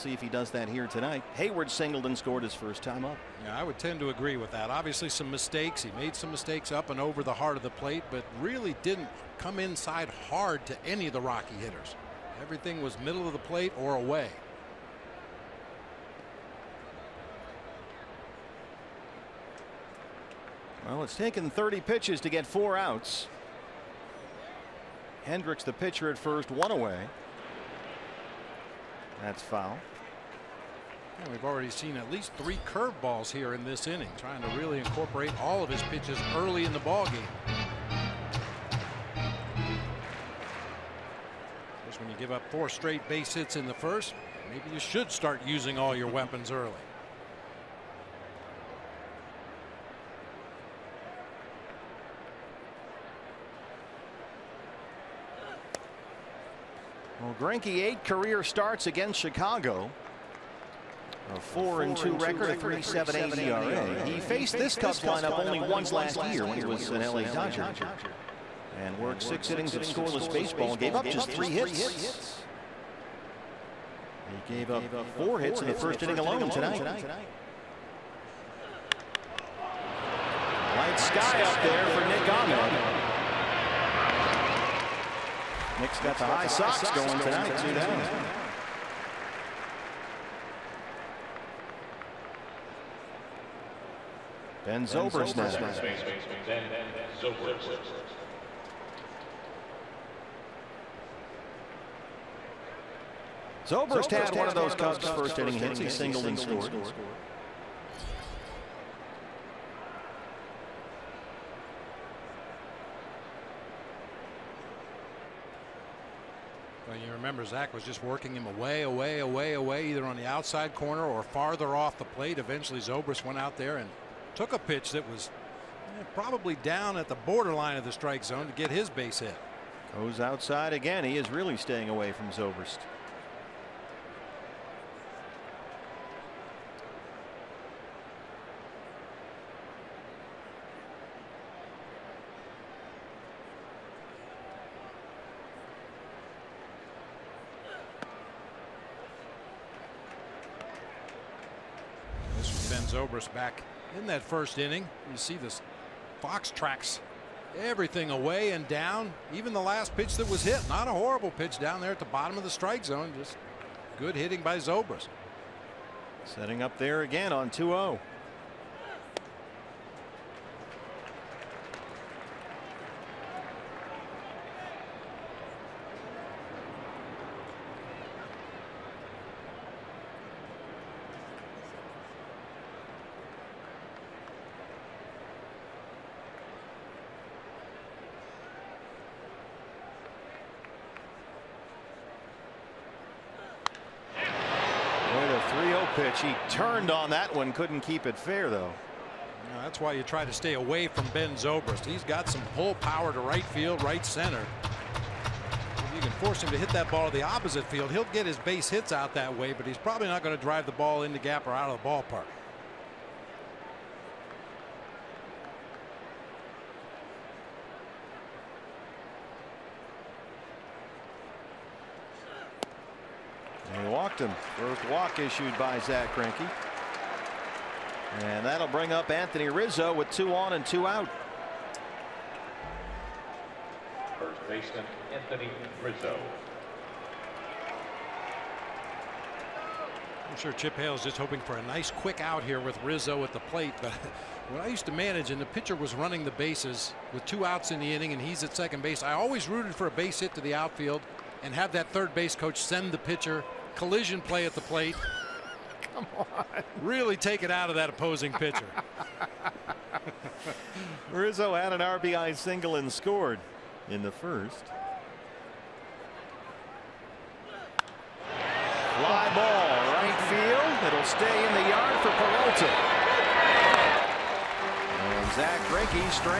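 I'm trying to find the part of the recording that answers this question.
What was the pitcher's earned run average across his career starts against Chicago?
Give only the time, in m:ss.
1:02.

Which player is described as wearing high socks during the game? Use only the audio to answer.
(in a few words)
Nick Ahmed.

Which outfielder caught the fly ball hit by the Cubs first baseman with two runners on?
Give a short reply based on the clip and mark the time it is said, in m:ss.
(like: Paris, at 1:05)
Peralta, at 4:32.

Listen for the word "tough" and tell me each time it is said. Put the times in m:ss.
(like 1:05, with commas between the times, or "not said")
not said.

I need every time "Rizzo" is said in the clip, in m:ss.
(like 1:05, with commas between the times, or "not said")
3:49, 3:55, 4:02, 4:21.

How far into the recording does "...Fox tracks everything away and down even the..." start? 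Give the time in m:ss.
2:36.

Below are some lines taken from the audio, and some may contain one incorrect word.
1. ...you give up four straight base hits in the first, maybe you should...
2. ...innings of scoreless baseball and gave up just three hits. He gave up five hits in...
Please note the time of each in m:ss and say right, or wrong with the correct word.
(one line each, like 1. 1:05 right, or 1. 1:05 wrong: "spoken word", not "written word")
1. 0:42 right
2. 1:09 wrong: "four", not "five".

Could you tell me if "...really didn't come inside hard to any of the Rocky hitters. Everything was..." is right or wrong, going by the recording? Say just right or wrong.
right.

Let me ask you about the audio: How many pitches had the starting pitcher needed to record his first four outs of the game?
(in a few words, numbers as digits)
30.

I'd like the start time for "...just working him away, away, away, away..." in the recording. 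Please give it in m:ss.
1:57.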